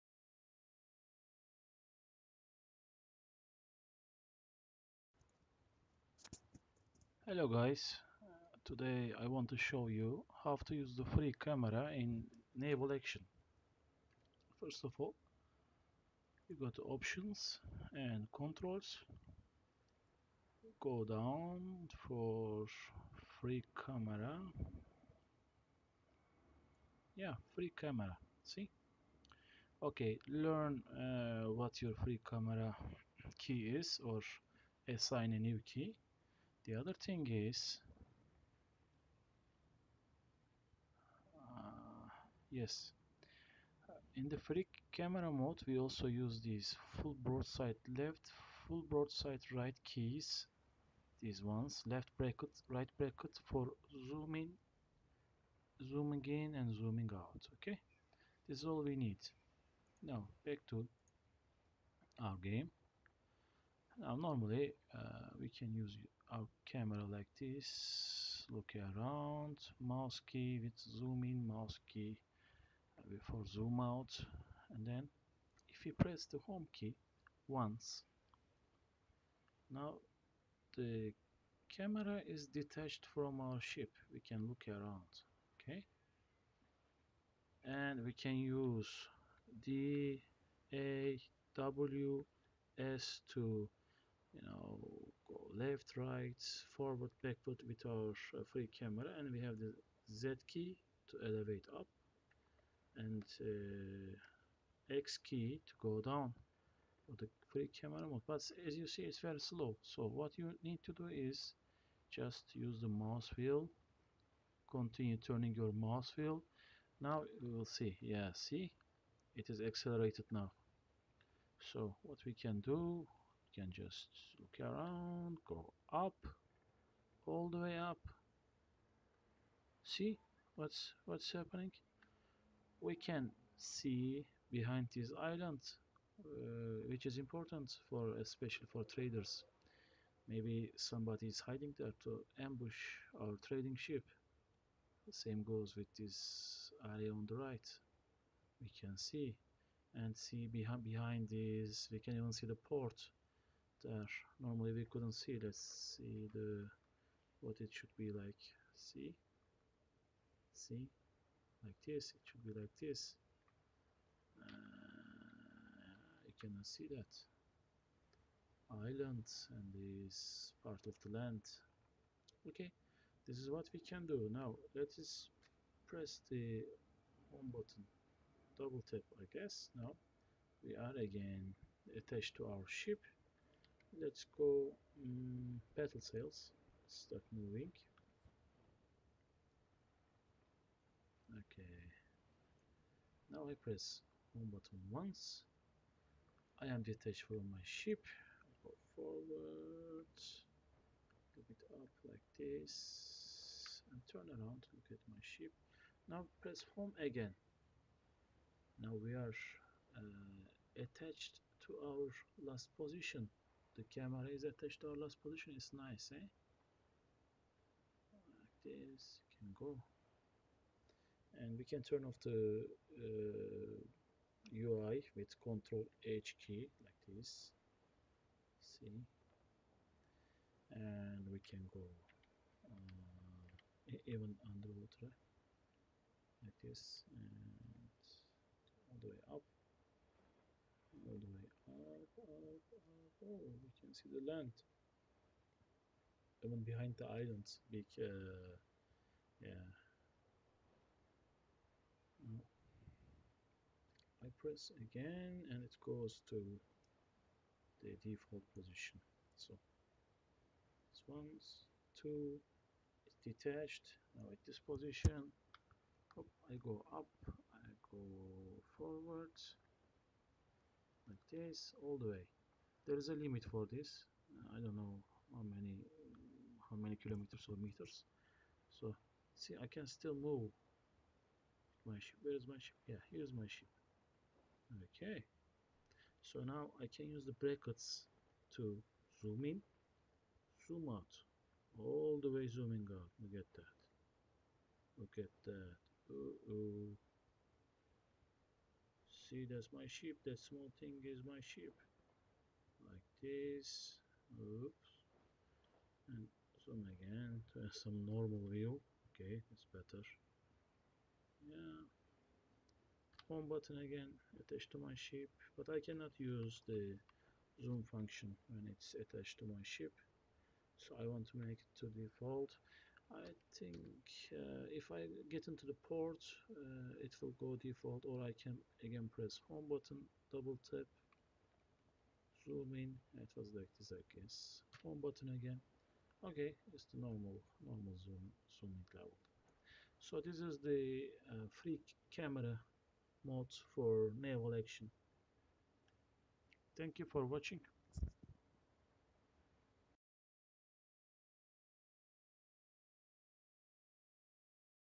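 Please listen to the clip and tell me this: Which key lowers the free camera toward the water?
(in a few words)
X.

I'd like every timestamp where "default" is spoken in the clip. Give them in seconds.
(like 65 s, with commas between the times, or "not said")
258 s, 321 s, 327 s.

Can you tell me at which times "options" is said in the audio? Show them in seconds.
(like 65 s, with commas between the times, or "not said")
16 s.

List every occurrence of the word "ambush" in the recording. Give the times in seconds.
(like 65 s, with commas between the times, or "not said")
142 s.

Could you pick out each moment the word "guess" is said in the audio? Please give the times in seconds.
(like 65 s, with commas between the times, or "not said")
179 s, 334 s.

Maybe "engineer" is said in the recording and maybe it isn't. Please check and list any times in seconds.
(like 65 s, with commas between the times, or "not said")
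not said.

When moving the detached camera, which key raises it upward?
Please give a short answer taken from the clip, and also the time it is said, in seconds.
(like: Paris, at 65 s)
Z, at 100 s.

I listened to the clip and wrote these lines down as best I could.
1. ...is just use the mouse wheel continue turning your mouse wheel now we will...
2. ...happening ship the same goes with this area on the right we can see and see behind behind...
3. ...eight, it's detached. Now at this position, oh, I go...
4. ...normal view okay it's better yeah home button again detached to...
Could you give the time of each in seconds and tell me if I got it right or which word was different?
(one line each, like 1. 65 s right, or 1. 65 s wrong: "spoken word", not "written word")
1. 111 s right
2. 143 s wrong: "trading", not "happening"
3. 262 s wrong: "two", not "eight"
4. 308 s wrong: "attached", not "detached".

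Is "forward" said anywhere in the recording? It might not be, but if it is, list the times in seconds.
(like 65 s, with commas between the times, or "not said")
96 s, 198 s, 268 s.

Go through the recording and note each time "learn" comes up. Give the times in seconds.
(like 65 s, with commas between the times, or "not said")
30 s.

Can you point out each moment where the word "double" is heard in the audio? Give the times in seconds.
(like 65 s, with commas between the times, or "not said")
178 s, 330 s.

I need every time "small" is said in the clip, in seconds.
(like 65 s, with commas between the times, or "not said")
300 s.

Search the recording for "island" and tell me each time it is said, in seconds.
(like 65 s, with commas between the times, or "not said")
135 s, 168 s, 247 s.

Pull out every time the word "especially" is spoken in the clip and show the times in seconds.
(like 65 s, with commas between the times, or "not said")
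138 s.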